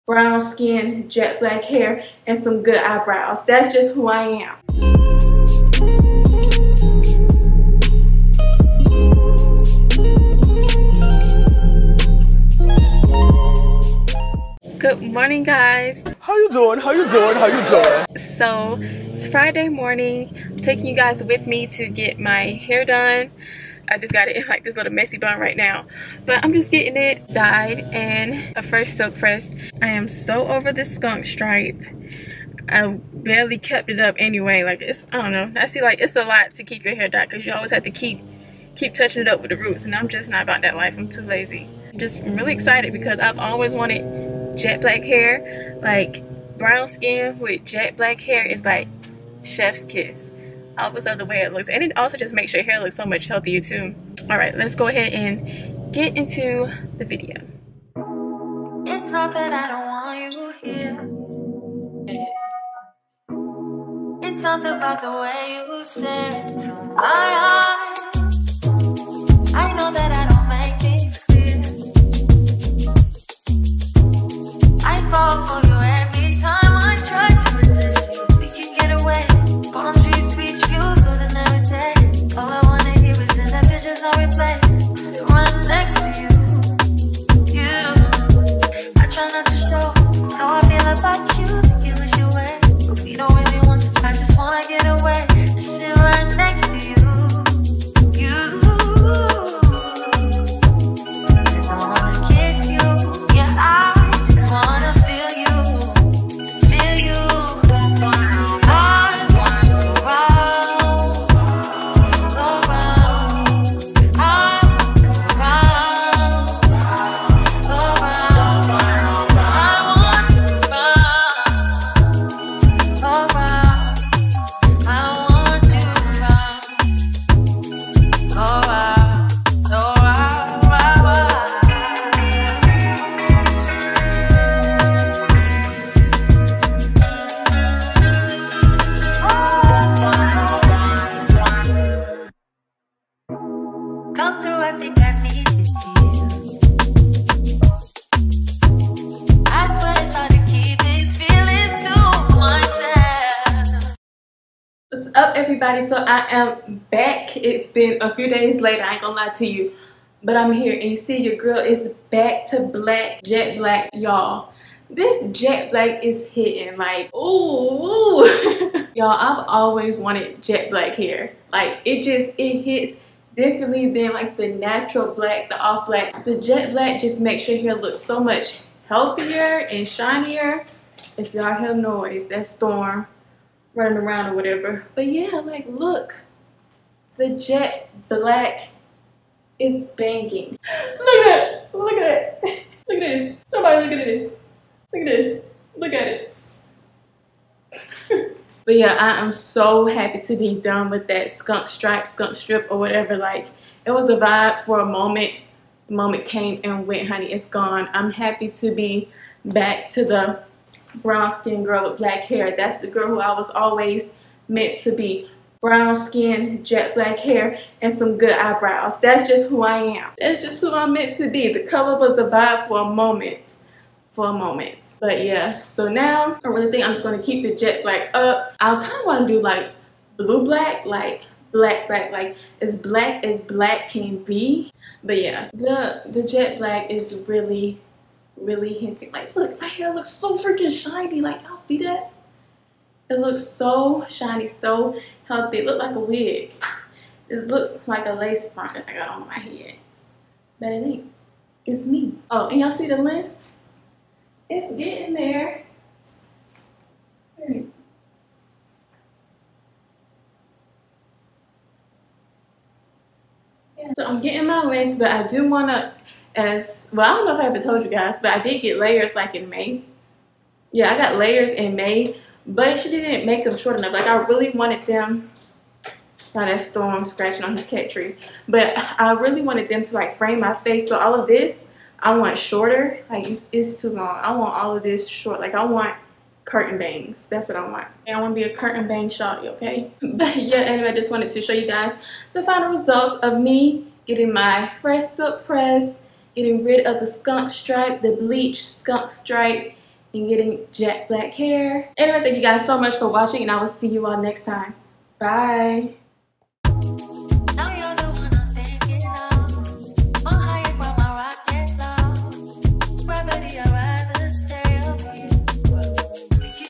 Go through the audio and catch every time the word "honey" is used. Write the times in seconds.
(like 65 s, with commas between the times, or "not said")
207 s.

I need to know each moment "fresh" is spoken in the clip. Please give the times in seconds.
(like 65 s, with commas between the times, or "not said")
28 s, 294 s.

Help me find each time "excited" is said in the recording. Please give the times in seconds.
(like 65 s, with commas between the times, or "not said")
42 s.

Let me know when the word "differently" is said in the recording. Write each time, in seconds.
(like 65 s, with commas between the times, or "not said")
173 s.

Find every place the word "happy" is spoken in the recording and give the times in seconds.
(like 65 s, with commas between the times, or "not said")
199 s, 208 s.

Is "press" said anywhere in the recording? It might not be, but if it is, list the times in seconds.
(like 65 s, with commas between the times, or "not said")
29 s, 295 s.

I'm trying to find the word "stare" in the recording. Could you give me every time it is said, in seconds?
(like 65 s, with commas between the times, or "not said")
65 s.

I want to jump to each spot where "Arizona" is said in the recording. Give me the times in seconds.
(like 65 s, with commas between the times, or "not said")
not said.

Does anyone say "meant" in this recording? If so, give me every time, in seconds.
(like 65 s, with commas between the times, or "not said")
214 s, 220 s.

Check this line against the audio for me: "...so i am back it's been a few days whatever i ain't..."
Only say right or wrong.
wrong.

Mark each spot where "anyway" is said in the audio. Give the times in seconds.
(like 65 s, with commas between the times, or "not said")
34 s, 290 s, 301 s.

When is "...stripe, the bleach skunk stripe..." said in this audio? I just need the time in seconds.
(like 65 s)
297 s.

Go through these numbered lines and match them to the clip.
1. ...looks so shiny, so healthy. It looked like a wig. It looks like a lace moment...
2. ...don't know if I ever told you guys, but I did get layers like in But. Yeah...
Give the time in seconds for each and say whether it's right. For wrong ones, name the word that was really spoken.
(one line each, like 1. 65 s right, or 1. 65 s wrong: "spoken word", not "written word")
1. 243 s wrong: "front", not "moment"
2. 267 s wrong: "May", not "But".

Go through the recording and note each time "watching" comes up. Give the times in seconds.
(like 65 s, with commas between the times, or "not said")
303 s.